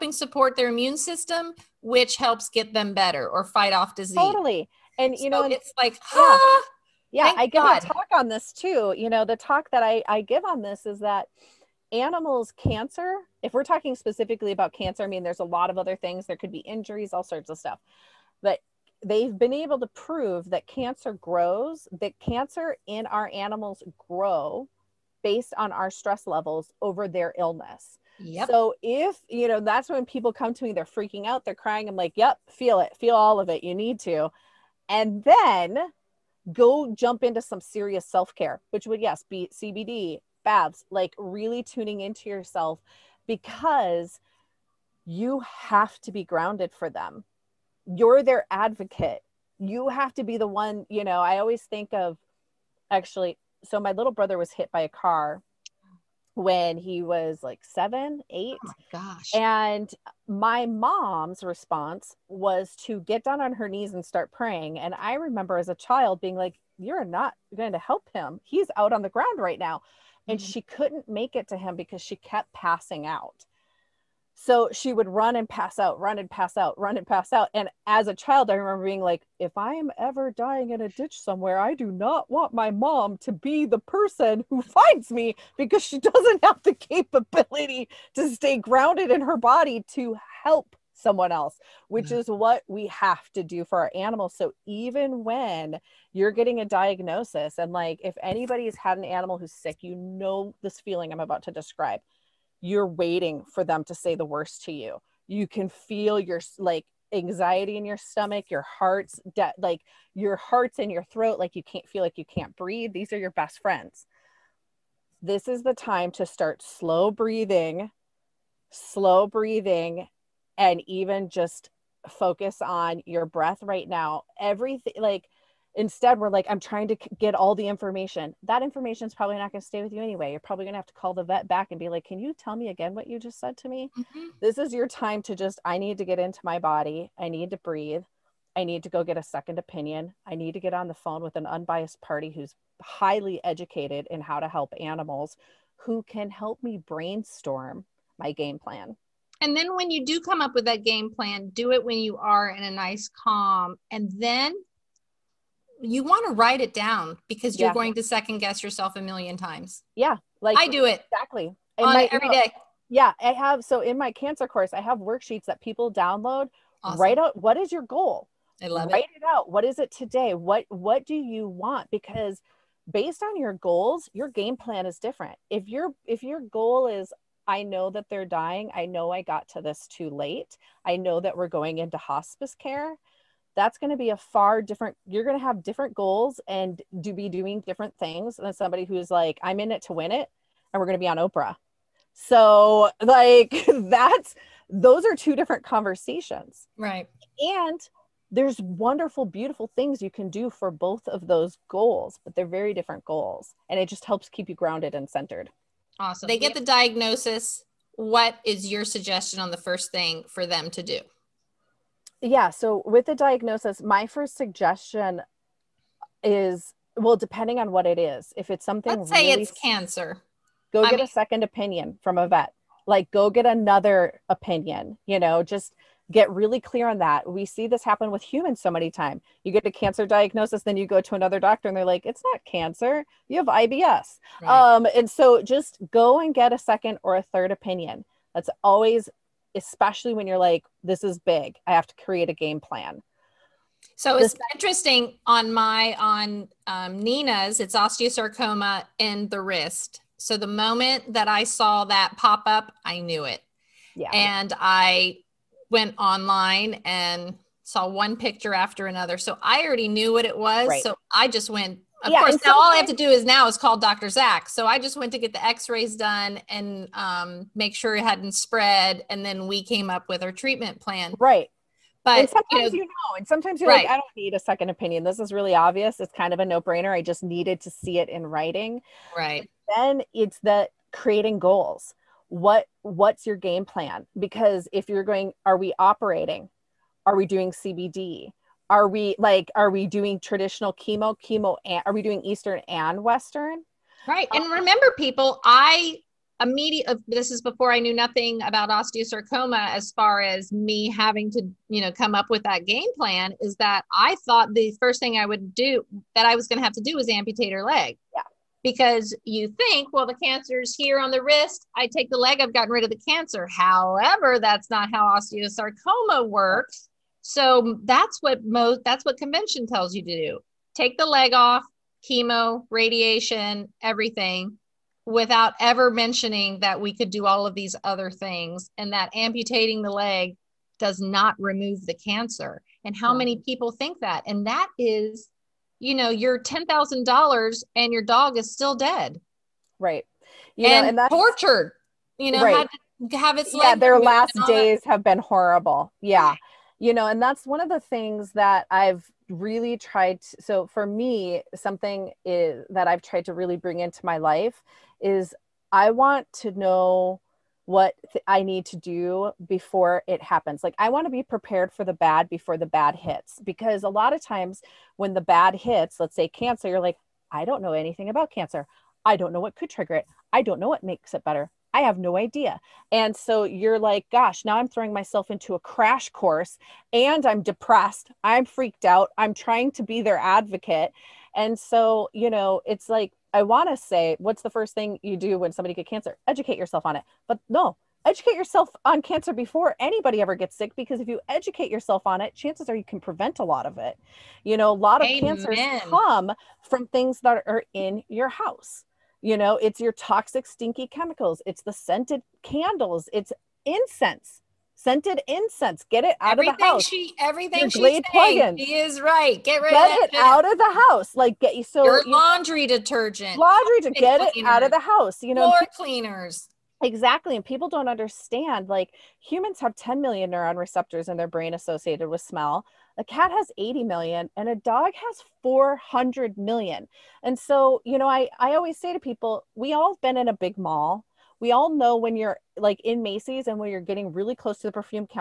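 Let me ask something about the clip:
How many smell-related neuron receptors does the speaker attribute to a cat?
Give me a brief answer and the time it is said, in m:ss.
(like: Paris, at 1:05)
80 million, at 7:03.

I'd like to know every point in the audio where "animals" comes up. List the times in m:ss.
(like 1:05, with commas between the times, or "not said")
0:11, 0:23, 1:33, 1:39, 2:24.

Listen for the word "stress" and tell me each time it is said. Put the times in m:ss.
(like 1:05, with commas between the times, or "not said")
0:25.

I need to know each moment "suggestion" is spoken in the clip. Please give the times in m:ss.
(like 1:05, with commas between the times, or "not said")
3:28, 3:34.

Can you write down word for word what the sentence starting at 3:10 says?
And we're going to be on Oprah.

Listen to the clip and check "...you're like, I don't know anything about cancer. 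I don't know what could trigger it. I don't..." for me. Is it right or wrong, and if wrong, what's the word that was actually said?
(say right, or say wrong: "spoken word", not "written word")
right.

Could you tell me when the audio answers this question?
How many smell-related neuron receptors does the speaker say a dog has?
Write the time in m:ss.
7:05.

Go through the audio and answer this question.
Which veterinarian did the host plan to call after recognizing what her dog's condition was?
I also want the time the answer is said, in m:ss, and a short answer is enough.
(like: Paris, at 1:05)
Dr. Zach, at 4:23.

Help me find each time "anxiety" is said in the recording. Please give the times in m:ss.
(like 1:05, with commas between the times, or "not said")
1:47.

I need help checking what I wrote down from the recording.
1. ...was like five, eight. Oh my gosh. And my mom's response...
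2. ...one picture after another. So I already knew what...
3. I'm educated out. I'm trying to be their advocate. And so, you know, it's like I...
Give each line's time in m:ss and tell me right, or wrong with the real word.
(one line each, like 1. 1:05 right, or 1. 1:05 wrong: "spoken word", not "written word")
1. 0:57 wrong: "seven", not "five"
2. 4:17 right
3. 6:18 wrong: "freaked", not "educated".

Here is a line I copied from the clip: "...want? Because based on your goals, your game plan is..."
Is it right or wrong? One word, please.
right.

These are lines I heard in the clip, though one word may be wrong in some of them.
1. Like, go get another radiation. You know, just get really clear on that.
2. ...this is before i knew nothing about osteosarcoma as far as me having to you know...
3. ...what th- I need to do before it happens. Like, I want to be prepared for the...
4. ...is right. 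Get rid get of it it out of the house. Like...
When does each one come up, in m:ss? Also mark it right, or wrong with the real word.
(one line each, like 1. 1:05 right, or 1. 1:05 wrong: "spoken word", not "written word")
1. 3:42 wrong: "opinion", not "radiation"
2. 4:57 right
3. 5:57 right
4. 6:48 right.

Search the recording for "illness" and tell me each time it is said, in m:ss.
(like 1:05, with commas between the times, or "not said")
0:27.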